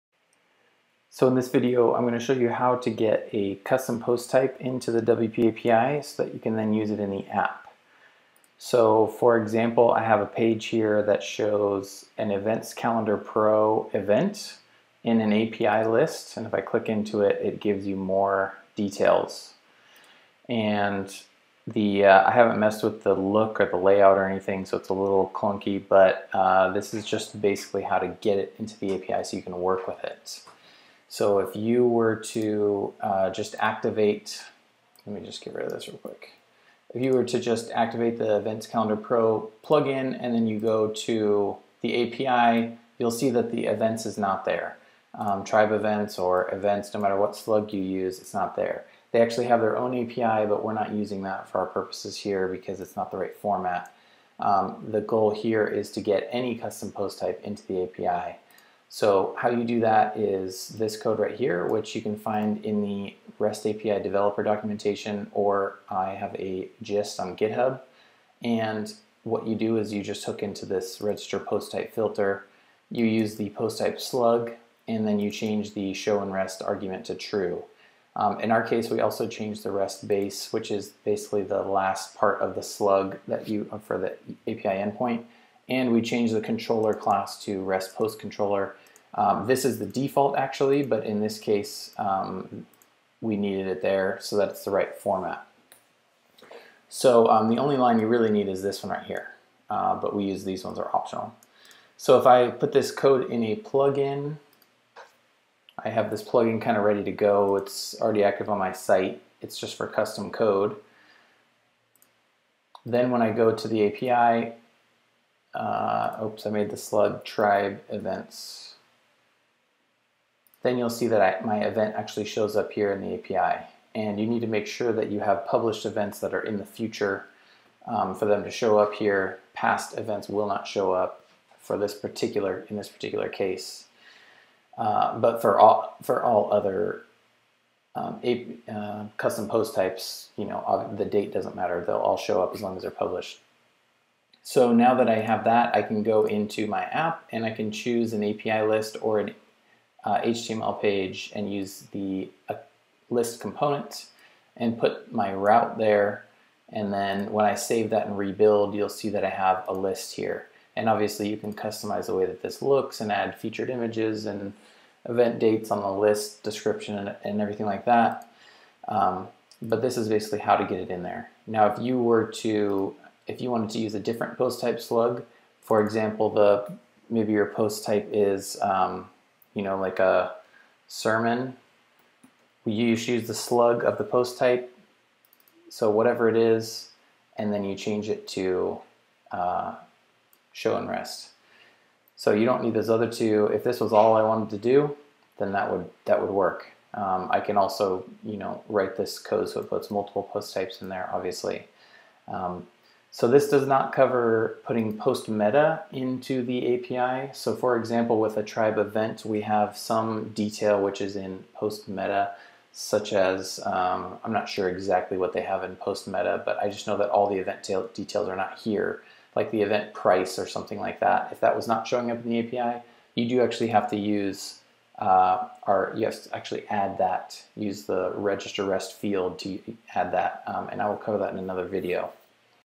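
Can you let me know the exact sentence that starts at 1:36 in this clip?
So um, the only line you really need is this one right here, uh, but we use these ones are optional.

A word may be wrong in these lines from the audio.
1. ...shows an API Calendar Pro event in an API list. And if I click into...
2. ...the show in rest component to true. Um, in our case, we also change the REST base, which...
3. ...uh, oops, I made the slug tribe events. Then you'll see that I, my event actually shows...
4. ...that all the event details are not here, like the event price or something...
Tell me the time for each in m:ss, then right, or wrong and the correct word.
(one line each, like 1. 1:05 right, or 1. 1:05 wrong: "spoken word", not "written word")
1. 0:11 wrong: "Events", not "API"
2. 1:15 wrong: "argument", not "component"
3. 1:55 right
4. 3:36 right.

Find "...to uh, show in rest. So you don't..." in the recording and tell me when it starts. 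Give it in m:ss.
3:08.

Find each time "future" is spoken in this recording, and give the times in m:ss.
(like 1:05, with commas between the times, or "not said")
2:06.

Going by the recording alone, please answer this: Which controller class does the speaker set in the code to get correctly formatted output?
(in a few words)
REST post controller.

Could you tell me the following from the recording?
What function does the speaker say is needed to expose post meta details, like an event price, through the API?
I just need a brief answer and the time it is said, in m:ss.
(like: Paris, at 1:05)
register rest field, at 3:48.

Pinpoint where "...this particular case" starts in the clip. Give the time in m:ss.
2:12.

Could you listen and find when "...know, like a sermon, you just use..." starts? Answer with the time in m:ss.
2:59.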